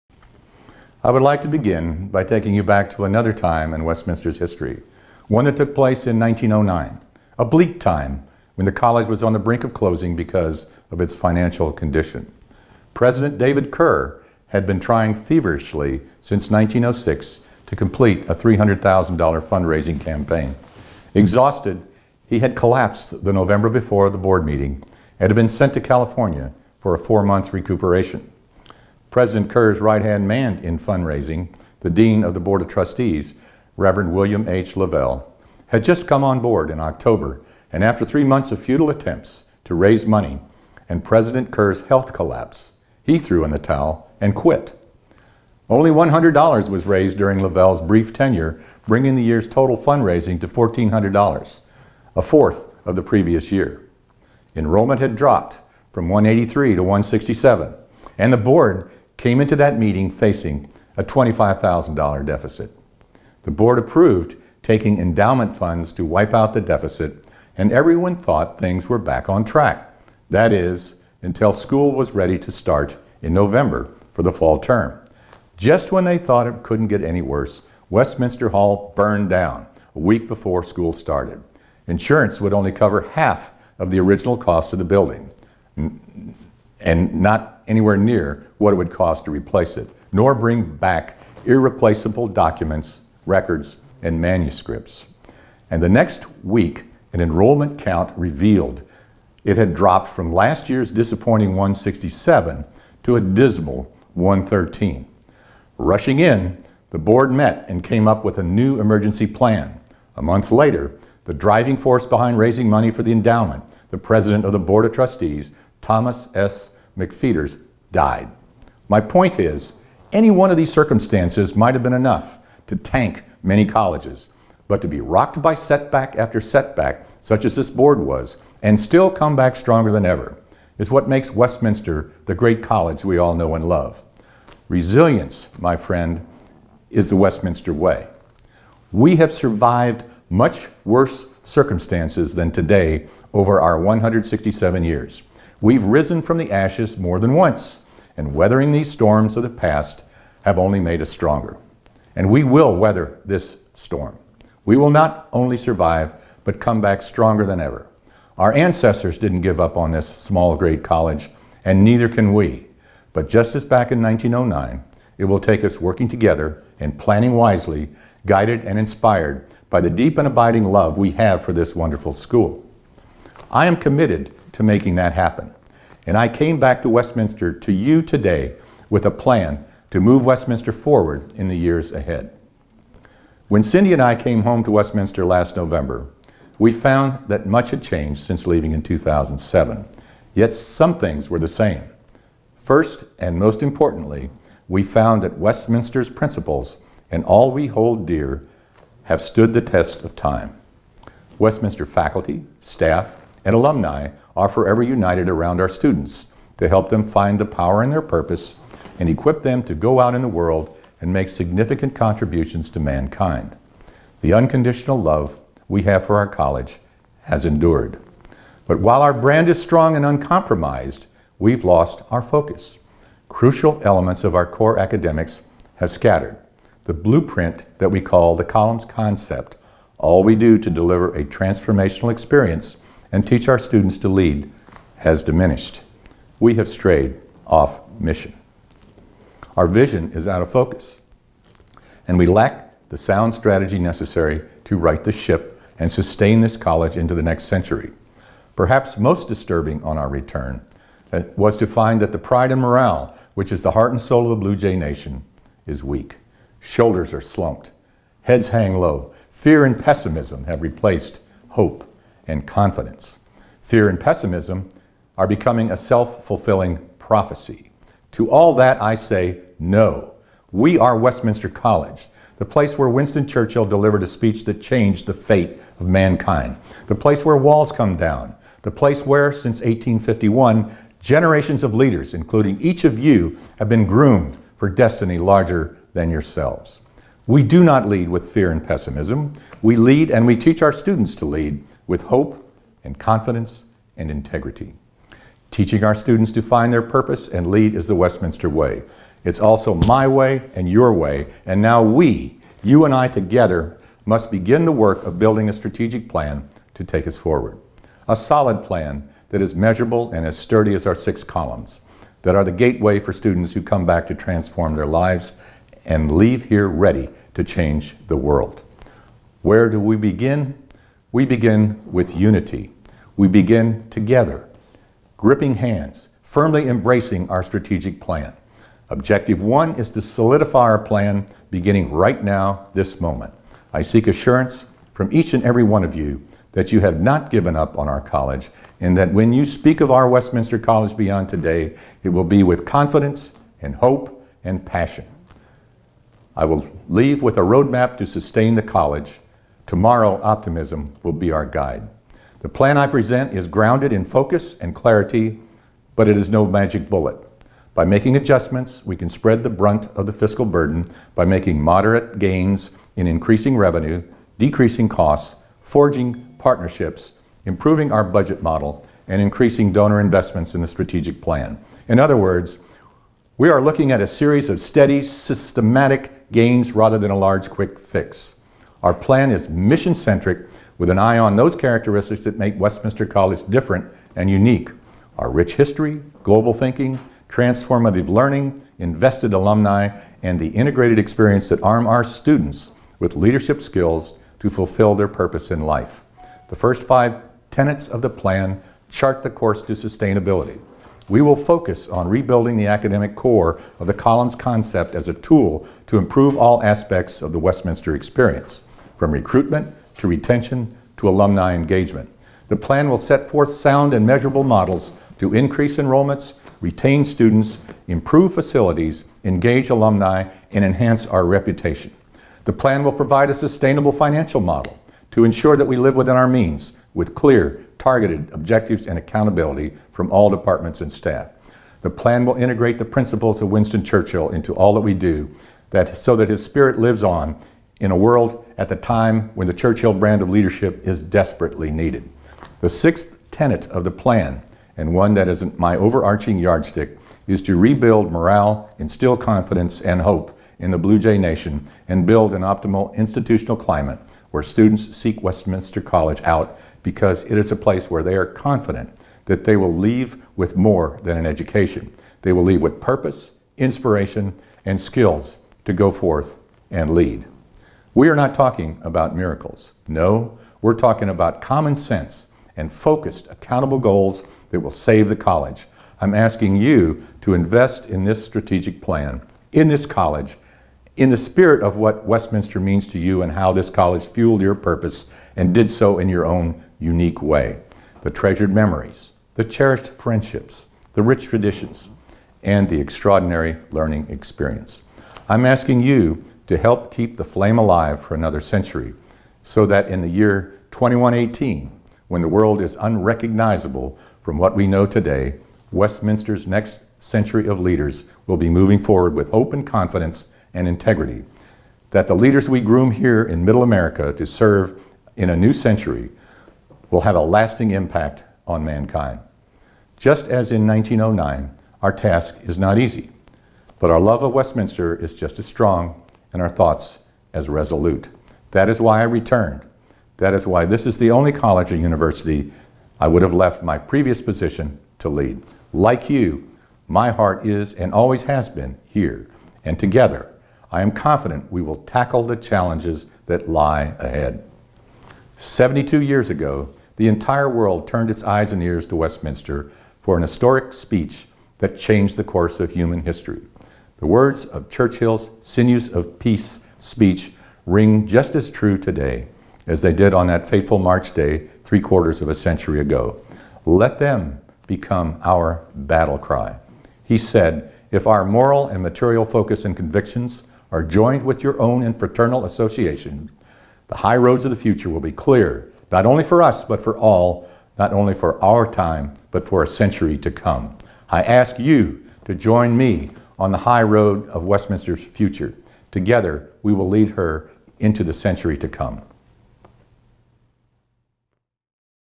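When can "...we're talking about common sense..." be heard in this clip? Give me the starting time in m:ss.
7:50.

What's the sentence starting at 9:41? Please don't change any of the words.
I ask you to join me on the high road of Westminster's future.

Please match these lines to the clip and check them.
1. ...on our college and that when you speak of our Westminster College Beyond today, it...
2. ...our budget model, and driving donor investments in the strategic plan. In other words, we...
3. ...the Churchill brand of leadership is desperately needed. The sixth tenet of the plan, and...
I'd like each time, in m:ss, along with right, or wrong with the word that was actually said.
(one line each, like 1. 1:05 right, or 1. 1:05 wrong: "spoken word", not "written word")
1. 5:37 right
2. 6:07 wrong: "increasing", not "driving"
3. 7:19 right.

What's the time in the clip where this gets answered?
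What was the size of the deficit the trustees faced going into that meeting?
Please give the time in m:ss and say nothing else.
1:01.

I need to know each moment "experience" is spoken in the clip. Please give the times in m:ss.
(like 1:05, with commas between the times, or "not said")
3:52, 6:30, 6:47, 8:14.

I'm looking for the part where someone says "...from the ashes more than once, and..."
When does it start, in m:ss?
2:26.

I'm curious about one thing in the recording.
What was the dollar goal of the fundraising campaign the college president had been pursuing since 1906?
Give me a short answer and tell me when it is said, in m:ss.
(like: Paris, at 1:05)
$300,000, at 0:18.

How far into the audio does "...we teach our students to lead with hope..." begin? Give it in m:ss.
4:50.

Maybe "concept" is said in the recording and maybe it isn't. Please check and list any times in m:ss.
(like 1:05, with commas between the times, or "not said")
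3:48, 6:44.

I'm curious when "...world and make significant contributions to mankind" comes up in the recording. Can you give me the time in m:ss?
3:30.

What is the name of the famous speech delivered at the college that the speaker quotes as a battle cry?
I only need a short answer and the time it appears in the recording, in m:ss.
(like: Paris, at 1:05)
Sinews of Peace, at 9:15.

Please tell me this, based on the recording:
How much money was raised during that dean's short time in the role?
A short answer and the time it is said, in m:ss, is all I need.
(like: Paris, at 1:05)
$100, at 0:45.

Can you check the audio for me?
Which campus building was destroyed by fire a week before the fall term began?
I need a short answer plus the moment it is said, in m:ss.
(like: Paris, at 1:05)
Westminster Hall, at 1:17.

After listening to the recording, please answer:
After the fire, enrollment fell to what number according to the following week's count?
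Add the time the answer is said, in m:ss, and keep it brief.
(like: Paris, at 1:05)
113, at 1:44.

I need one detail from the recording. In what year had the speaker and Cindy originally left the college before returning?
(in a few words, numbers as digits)
2007.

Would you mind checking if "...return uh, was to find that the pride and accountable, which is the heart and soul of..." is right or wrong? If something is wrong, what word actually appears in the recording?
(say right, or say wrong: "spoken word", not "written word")
wrong: "morale", not "accountable".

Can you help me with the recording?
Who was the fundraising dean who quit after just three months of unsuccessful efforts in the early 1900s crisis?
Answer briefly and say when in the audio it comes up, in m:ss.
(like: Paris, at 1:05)
William H. Lavelle, at 0:34.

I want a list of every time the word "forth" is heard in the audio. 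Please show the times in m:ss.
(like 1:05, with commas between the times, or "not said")
6:53, 7:45.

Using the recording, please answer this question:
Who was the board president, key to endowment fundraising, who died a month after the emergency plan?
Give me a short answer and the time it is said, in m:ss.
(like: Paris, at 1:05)
Thomas S. McFeeters, at 1:55.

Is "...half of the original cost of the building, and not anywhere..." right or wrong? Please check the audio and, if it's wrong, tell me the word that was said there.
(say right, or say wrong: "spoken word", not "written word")
right.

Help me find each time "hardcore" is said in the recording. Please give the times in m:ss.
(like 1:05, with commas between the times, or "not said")
not said.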